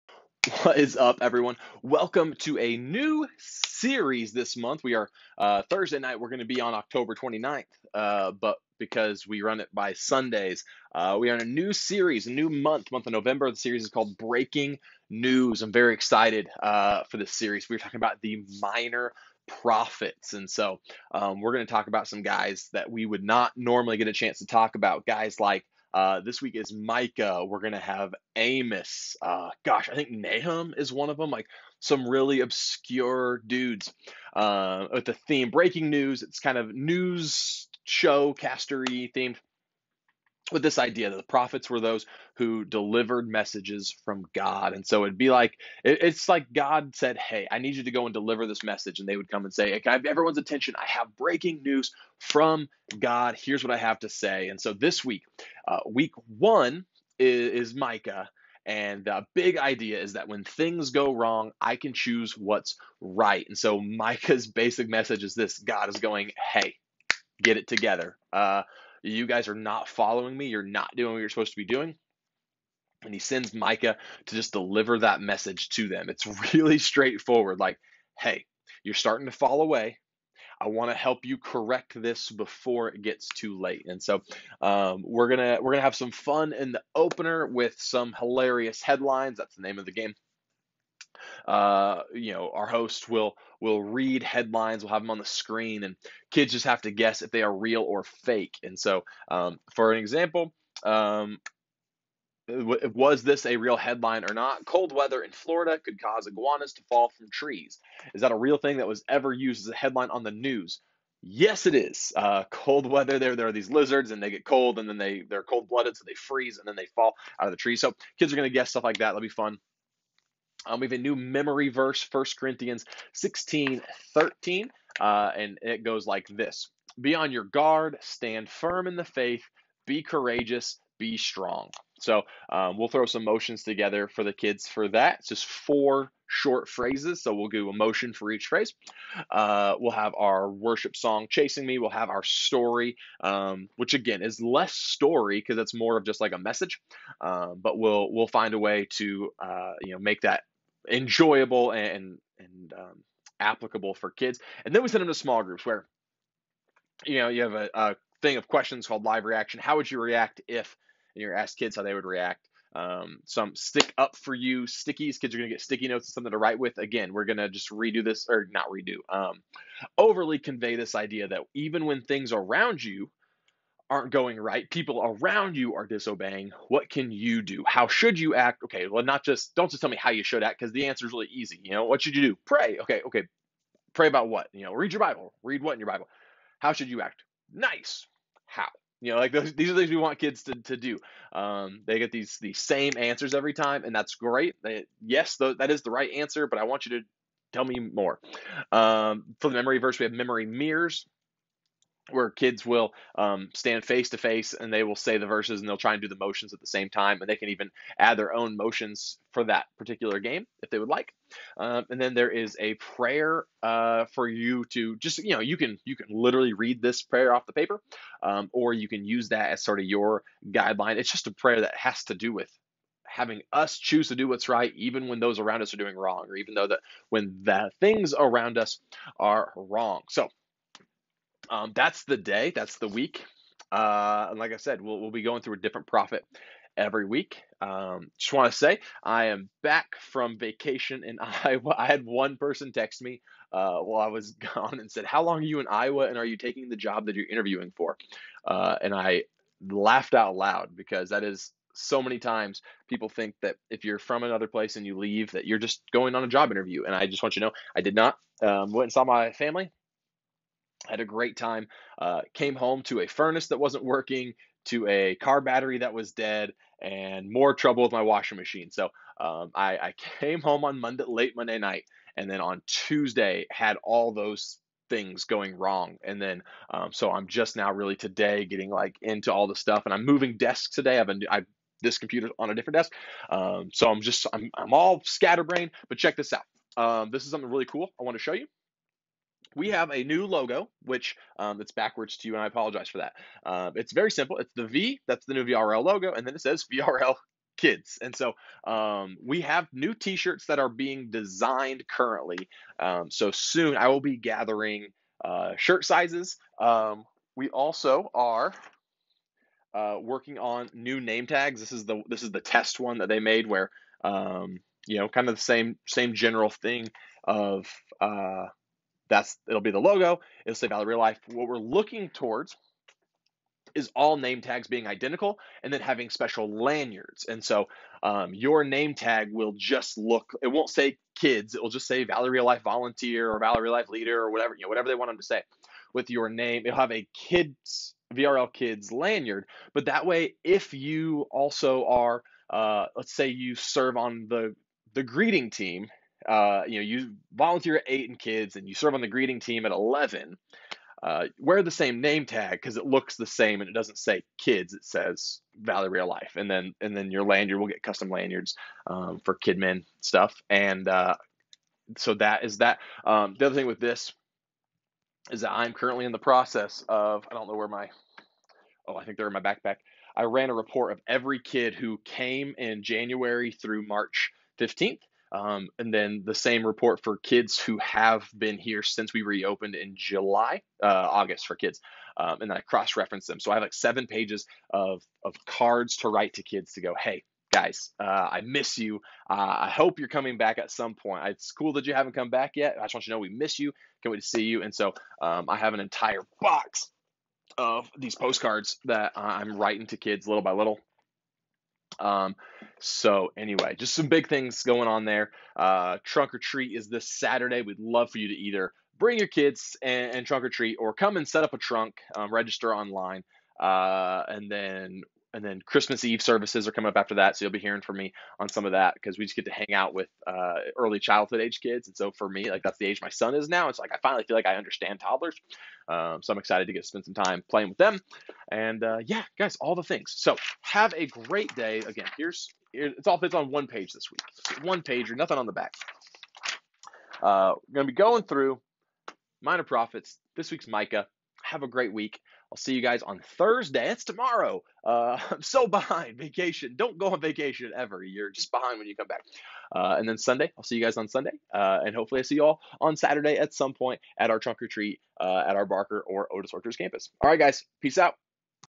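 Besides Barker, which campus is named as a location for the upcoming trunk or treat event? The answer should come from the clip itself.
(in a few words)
Otis Orchards.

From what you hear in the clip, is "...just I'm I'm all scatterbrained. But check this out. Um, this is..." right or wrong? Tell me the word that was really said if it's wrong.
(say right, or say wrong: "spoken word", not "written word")
right.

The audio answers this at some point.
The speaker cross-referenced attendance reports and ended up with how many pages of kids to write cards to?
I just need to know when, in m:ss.
6:23.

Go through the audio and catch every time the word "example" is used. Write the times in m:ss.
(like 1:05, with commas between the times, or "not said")
1:39.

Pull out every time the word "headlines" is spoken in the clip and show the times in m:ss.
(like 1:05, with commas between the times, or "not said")
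1:28, 1:34, 1:43, 1:49.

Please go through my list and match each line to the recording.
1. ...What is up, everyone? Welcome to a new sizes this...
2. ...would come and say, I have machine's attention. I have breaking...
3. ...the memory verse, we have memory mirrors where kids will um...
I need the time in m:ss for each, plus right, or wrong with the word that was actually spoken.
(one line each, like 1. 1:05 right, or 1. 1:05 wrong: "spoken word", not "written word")
1. 0:00 wrong: "series", not "sizes"
2. 0:49 wrong: "everyone", not "machine"
3. 3:19 right.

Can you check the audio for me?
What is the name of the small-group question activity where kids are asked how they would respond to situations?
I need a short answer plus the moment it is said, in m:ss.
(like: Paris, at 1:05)
Live reaction, at 2:39.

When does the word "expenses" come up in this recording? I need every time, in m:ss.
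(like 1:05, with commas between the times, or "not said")
not said.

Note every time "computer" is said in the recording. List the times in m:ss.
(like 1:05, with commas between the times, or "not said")
4:41.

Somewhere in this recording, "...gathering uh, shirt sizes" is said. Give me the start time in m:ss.
5:04.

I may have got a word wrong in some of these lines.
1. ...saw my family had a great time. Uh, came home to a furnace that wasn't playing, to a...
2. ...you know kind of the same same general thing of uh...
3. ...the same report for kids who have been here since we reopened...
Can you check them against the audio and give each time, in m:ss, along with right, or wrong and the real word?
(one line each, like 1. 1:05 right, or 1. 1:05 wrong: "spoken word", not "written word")
1. 4:18 wrong: "working", not "playing"
2. 5:14 right
3. 6:16 right.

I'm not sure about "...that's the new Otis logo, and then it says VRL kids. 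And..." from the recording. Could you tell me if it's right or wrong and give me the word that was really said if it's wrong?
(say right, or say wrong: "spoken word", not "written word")
wrong: "VRL", not "Otis".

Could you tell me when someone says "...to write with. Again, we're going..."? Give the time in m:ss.
2:46.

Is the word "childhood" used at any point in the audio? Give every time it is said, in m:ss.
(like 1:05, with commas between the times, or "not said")
7:00.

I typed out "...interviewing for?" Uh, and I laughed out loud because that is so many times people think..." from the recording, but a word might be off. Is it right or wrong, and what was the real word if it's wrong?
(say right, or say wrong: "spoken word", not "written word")
right.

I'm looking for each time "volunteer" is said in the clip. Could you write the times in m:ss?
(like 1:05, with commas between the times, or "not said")
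5:32, 5:47.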